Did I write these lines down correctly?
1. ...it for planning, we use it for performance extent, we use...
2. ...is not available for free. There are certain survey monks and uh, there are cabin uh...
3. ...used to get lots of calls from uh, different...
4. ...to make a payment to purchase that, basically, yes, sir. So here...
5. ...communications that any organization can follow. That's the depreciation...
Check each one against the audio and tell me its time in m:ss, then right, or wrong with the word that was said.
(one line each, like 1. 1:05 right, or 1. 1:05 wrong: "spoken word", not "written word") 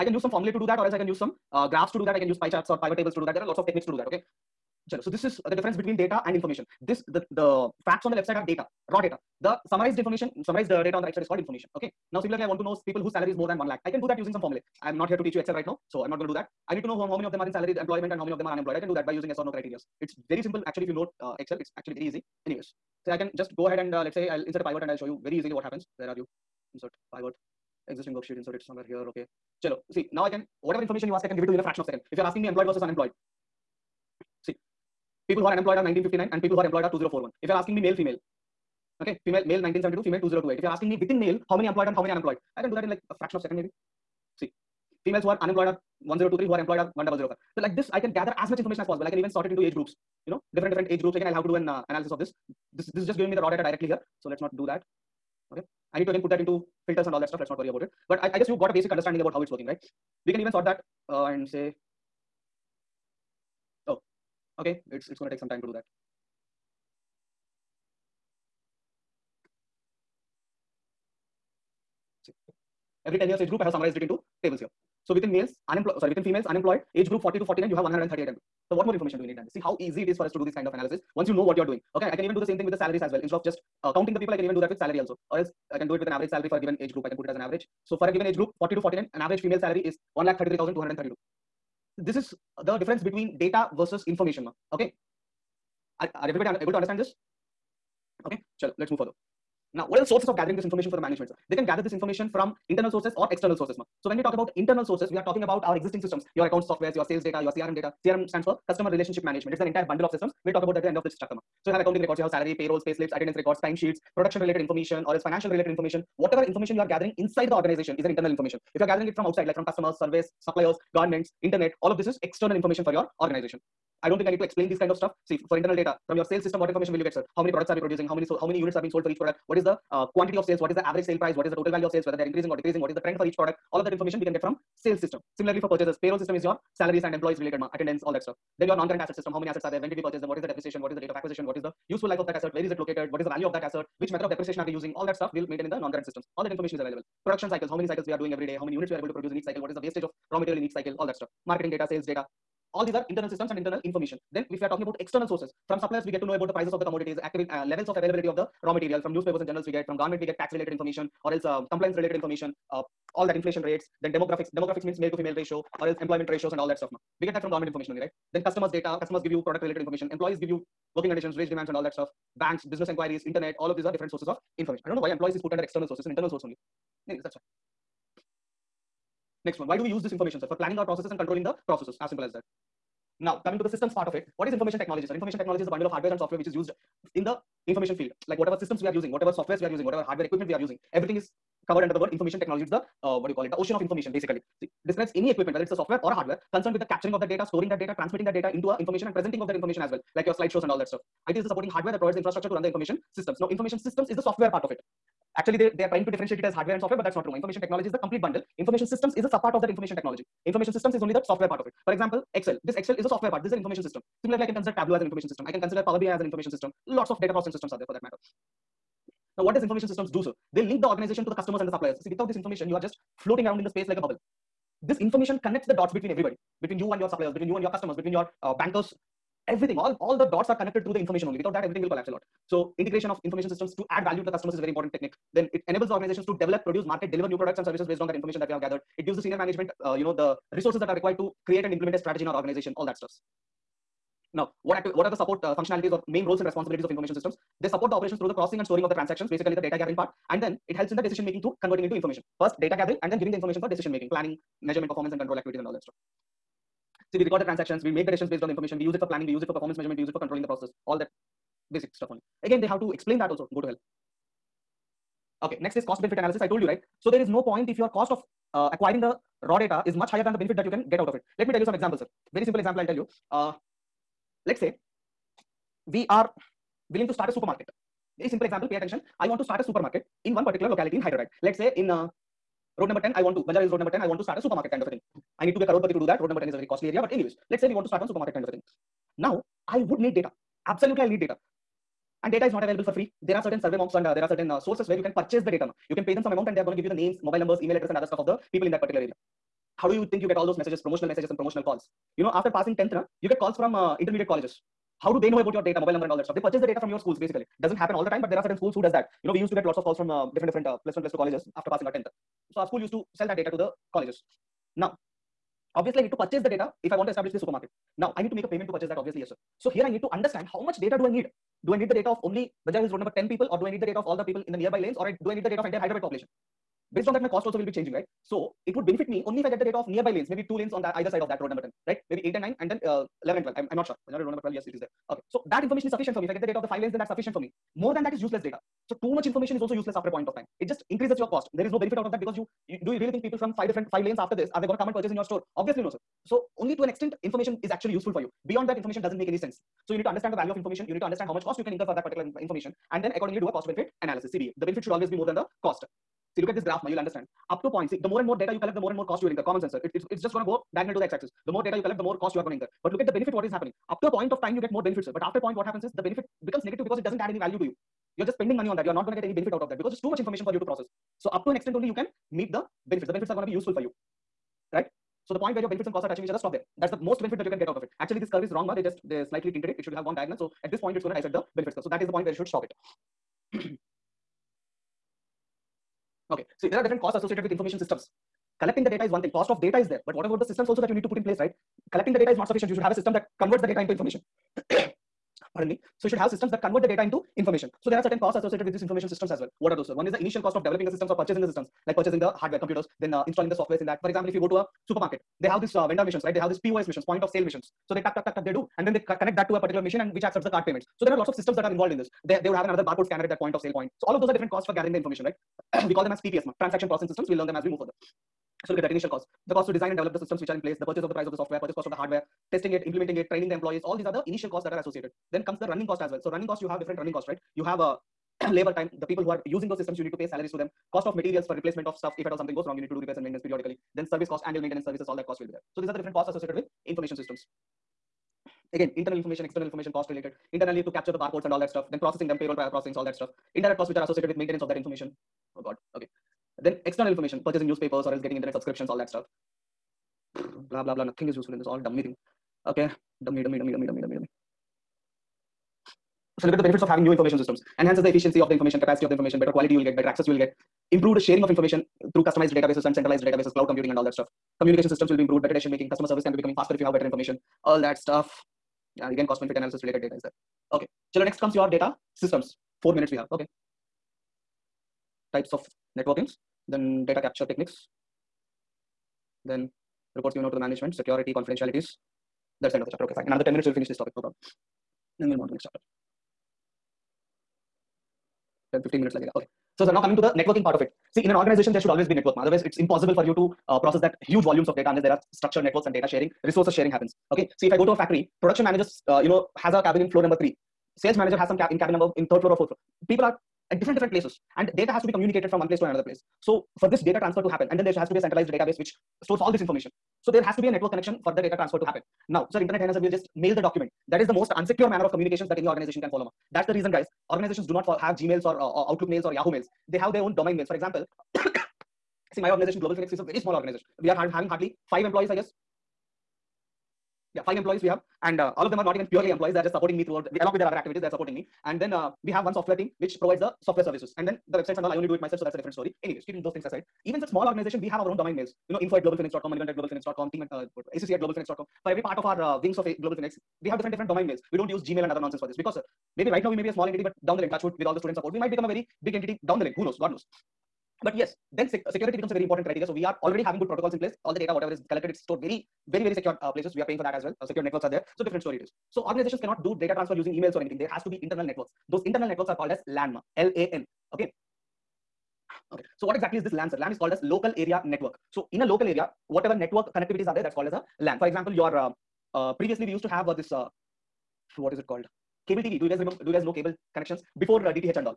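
1. 4:18 wrong: "measurement", not "extent"
2. 4:52 wrong: "certain", not "cabin"
3. 5:09 right
4. 5:18 wrong: "obviously", not "basically"
5. 8:35 wrong: "reason", not "depreciation".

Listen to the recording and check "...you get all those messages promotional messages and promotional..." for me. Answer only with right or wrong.
right.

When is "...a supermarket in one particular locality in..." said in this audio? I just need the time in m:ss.
4:39.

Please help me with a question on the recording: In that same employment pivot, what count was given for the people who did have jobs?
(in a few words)
2041.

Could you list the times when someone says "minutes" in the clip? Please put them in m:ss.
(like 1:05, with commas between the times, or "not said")
7:52, 8:03, 8:09.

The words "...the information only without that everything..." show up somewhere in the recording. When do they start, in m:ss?
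3:50.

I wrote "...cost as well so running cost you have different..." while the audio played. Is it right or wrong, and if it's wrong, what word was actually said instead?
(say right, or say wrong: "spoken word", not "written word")
right.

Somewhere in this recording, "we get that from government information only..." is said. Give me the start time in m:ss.
2:47.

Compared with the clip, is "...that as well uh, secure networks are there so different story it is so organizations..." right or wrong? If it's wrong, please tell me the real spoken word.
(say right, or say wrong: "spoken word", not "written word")
right.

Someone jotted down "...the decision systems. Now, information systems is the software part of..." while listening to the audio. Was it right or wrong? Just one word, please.
wrong.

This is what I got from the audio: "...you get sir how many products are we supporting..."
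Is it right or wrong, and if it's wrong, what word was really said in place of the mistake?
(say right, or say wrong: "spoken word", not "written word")
wrong: "producing", not "supporting".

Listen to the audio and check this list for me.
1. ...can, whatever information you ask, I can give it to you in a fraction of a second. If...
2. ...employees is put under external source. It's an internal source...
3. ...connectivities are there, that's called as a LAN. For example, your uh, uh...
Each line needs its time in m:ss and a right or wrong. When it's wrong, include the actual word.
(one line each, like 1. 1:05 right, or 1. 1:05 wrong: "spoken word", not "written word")
1. 0:30 right
2. 2:55 right
3. 9:29 right.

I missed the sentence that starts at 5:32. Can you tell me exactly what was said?
Maybe eight and nine, and then uh, eleven and twelve.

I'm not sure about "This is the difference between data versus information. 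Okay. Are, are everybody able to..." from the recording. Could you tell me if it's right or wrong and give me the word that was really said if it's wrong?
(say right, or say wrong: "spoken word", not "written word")
right.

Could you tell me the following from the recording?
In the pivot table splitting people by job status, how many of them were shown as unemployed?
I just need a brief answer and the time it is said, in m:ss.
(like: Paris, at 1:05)
1959, at 0:35.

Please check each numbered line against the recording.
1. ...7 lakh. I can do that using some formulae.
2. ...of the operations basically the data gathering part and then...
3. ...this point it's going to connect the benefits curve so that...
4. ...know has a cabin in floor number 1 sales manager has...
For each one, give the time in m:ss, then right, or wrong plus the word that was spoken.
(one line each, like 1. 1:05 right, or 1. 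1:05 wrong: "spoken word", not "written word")
1. 0:13 wrong: "1", not "7"
2. 4:08 wrong: "transactions", not "operations"
3. 6:20 wrong: "dissect", not "connect"
4. 8:19 wrong: "3", not "1".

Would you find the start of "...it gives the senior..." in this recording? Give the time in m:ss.
3:58.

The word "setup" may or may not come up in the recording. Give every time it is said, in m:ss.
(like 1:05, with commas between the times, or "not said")
not said.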